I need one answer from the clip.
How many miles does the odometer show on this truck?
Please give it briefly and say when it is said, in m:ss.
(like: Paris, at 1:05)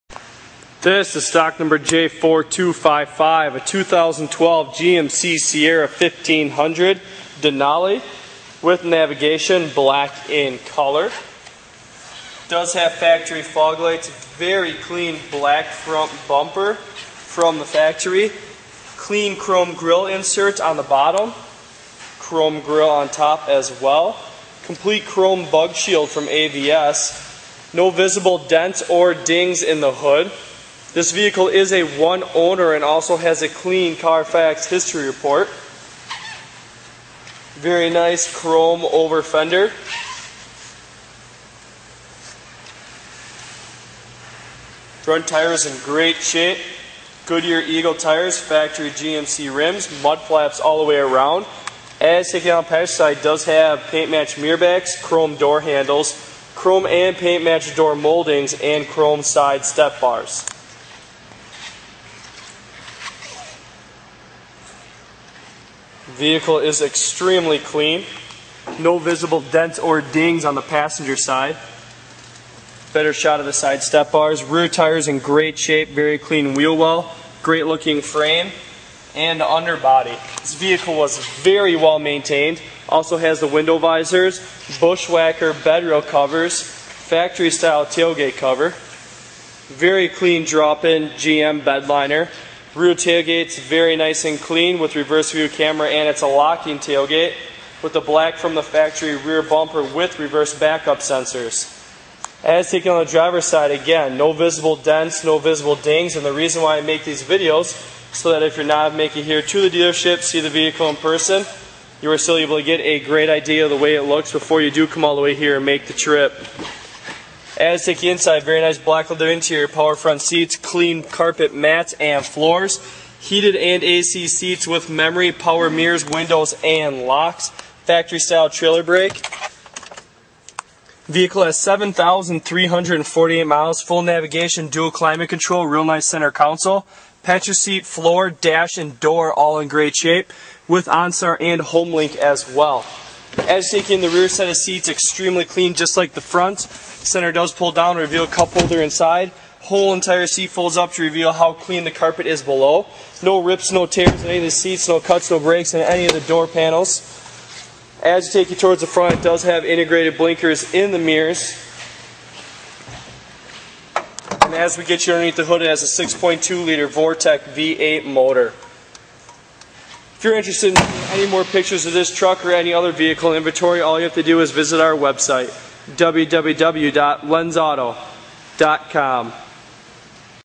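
7,348, at 2:11.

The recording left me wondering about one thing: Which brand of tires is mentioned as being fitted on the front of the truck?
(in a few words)
Goodyear Eagle.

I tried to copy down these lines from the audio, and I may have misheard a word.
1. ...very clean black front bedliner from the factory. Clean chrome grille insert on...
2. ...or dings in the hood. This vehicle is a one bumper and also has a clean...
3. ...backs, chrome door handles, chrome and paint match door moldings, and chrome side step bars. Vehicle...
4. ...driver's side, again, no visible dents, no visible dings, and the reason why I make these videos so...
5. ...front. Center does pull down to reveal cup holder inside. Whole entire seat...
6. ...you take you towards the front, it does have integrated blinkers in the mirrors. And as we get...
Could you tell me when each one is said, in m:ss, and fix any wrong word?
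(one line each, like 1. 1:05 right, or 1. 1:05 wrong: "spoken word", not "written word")
1. 0:14 wrong: "bumper", not "bedliner"
2. 0:28 wrong: "owner", not "bumper"
3. 0:54 right
4. 1:43 right
5. 2:26 right
6. 2:38 right.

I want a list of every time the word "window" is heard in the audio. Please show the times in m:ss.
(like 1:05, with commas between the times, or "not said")
1:23, 2:06.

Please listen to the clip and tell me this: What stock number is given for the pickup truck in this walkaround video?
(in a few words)
J4255.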